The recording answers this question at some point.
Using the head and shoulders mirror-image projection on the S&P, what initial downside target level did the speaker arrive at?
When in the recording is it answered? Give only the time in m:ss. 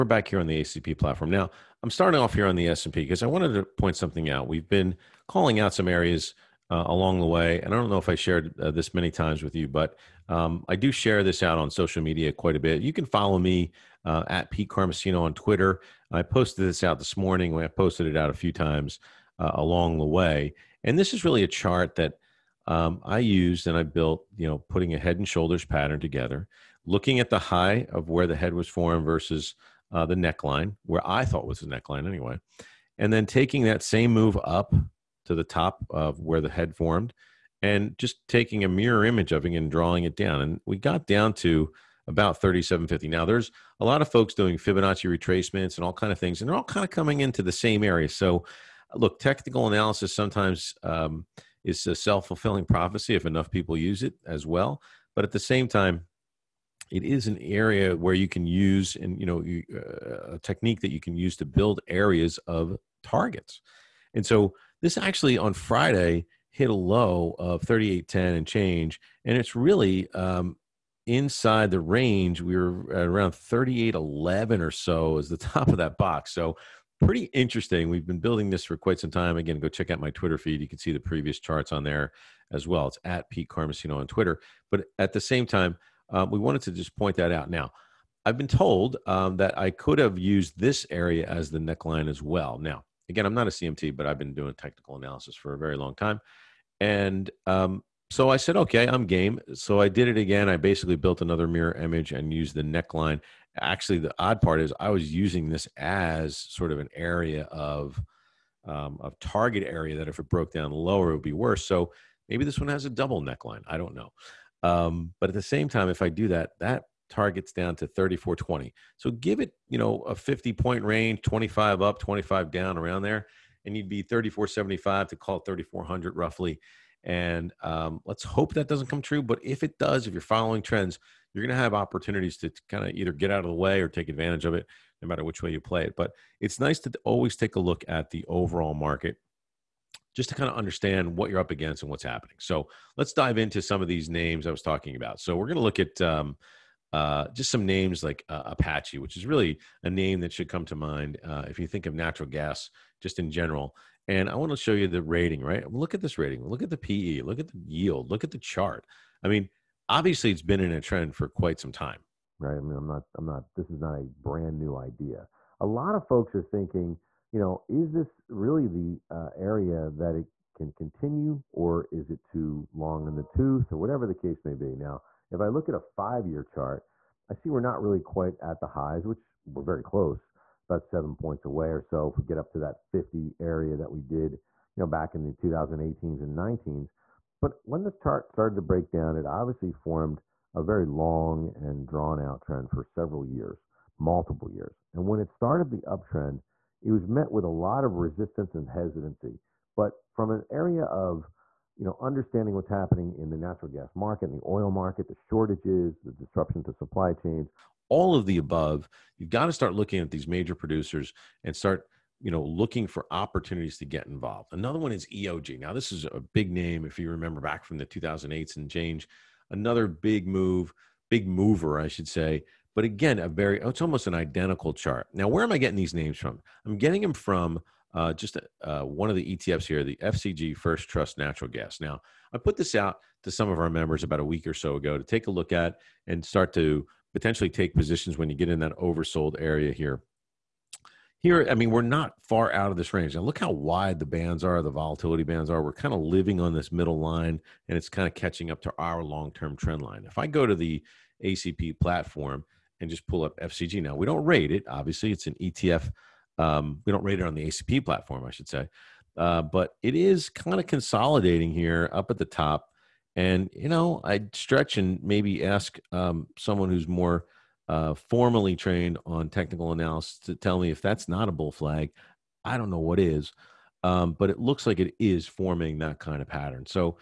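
0:42.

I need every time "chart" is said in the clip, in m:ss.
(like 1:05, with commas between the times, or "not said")
0:21, 1:21, 2:38, 2:56, 3:07, 3:44.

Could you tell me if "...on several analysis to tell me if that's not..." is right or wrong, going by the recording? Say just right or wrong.
wrong.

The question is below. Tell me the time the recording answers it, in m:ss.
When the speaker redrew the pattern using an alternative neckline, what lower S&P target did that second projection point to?
1:57.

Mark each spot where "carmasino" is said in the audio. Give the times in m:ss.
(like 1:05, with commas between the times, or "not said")
0:14, 1:23.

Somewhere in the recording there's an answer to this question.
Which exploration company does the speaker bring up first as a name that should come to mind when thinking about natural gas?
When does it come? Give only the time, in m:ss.
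2:28.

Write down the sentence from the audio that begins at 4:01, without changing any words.
Here, I mean, we're not far out of this range.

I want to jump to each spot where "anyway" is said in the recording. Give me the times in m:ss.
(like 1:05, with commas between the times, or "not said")
0:32.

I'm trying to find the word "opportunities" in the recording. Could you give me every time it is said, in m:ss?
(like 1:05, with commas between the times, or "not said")
2:11, 3:33.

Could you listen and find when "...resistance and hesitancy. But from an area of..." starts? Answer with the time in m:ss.
3:17.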